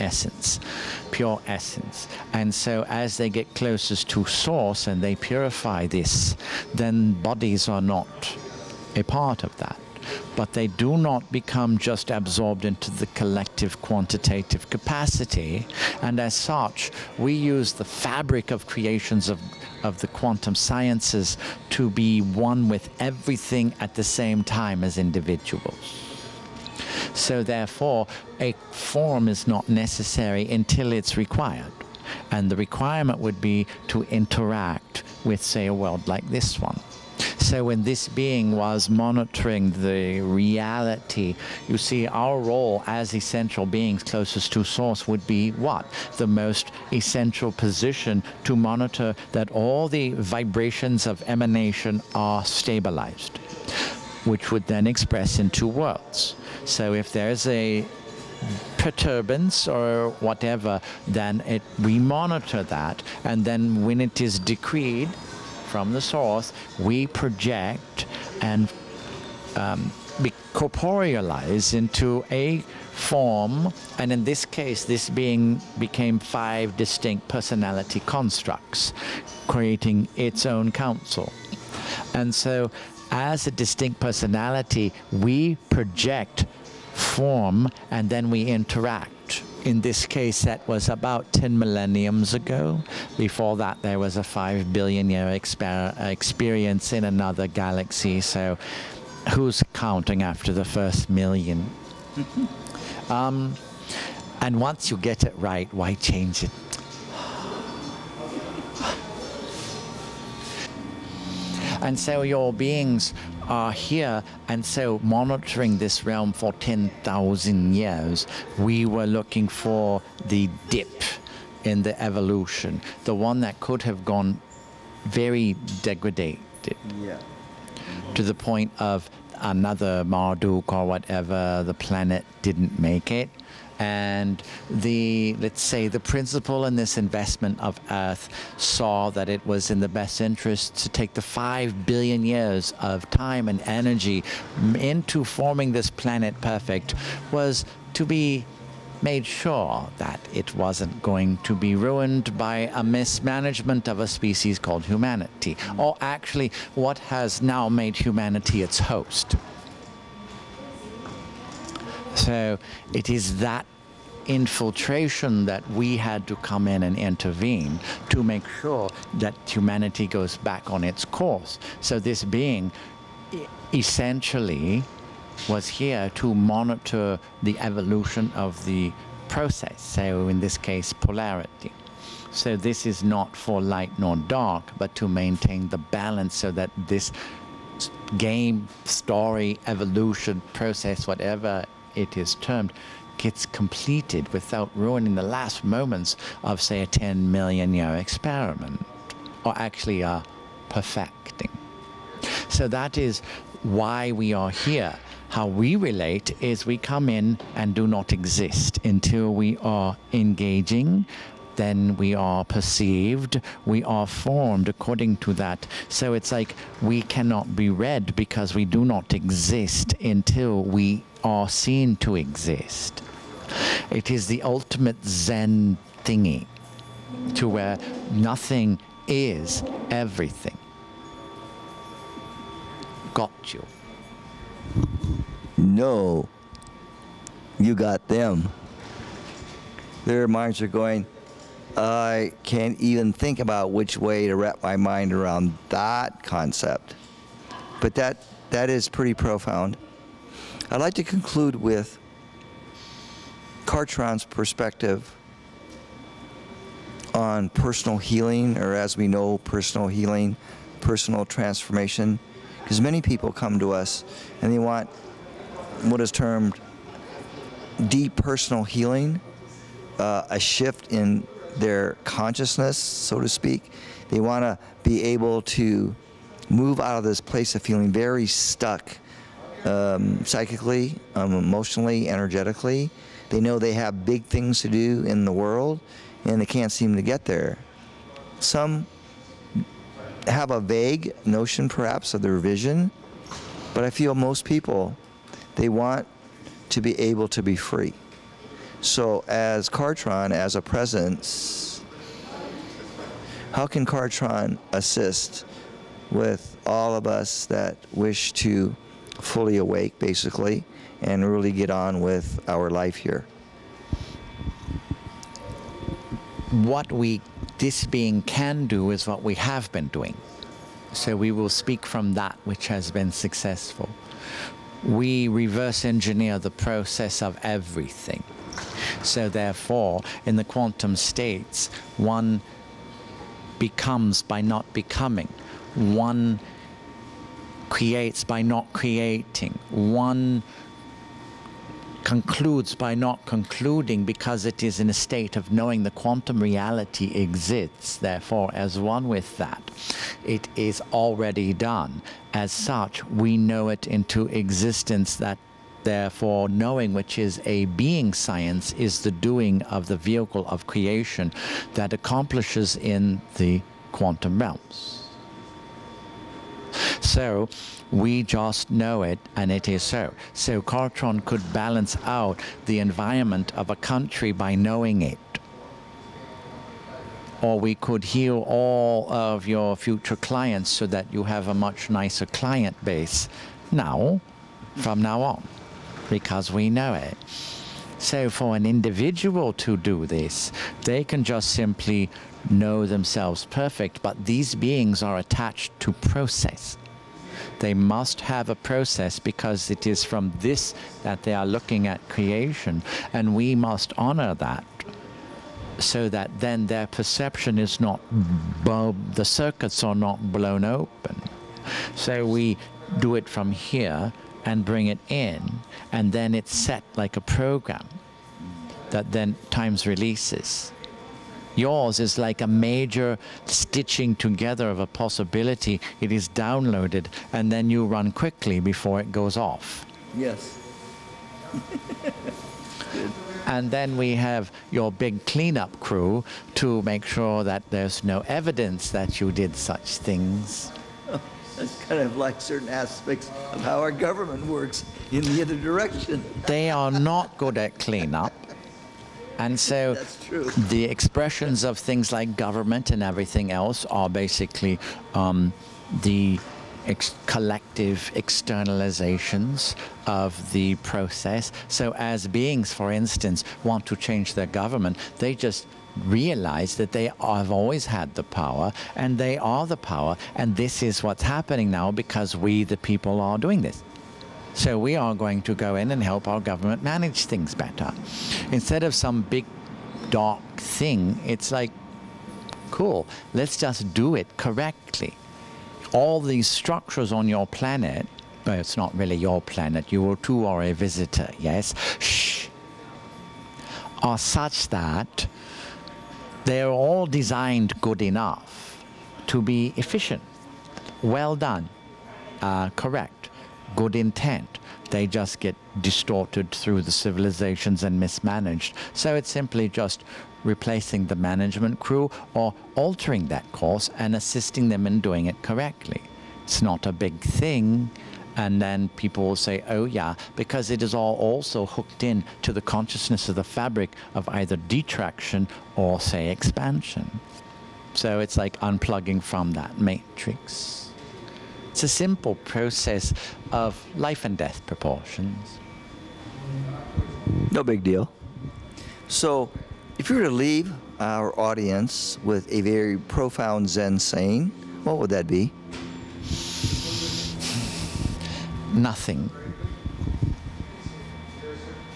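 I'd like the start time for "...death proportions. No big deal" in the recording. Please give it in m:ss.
8:54.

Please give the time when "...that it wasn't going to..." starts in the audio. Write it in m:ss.
2:29.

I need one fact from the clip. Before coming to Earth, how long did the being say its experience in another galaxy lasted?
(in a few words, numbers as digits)
5 billion years.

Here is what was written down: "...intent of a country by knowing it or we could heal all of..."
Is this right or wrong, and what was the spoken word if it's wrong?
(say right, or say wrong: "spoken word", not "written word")
wrong: "environment", not "intent".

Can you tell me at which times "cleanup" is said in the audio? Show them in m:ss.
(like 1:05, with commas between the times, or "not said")
7:15, 7:27.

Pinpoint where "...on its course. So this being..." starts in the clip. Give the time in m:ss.
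2:50.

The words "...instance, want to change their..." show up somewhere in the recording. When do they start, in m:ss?
7:42.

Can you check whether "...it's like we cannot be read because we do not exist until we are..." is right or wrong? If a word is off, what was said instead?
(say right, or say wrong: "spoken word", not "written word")
right.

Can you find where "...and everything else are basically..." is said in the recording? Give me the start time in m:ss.
7:32.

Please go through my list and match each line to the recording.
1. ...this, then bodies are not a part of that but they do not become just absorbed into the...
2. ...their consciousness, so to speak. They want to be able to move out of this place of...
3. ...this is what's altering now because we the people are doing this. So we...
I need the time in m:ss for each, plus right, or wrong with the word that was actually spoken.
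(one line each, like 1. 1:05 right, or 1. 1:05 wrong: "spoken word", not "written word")
1. 0:05 right
2. 4:31 right
3. 7:50 wrong: "happening", not "altering".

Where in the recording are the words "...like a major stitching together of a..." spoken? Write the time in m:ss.
7:02.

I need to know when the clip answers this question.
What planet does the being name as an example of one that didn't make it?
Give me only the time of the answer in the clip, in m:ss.
2:10.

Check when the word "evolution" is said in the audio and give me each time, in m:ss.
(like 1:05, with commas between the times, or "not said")
2:02, 2:57, 3:09.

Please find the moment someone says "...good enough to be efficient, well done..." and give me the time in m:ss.
8:17.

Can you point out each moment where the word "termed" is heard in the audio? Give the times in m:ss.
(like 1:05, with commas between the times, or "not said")
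3:12, 4:26.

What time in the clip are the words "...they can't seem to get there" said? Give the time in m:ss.
4:46.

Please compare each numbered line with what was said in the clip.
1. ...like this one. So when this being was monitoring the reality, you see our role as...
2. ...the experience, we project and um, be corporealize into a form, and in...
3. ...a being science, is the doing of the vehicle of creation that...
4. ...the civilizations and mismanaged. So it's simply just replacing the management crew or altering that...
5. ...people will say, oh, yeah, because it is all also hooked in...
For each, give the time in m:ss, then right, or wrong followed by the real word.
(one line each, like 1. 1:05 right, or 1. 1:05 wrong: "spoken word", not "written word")
1. 0:36 right
2. 1:05 wrong: "source", not "experience"
3. 5:57 right
4. 8:26 right
5. 8:38 right.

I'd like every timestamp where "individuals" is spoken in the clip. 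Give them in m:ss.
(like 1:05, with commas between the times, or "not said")
0:24, 6:28.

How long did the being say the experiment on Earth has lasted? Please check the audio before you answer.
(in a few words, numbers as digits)
10 million years.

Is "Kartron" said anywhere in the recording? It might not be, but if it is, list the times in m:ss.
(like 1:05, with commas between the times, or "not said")
4:13, 4:59, 5:03, 6:10.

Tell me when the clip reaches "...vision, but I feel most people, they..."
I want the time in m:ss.
4:52.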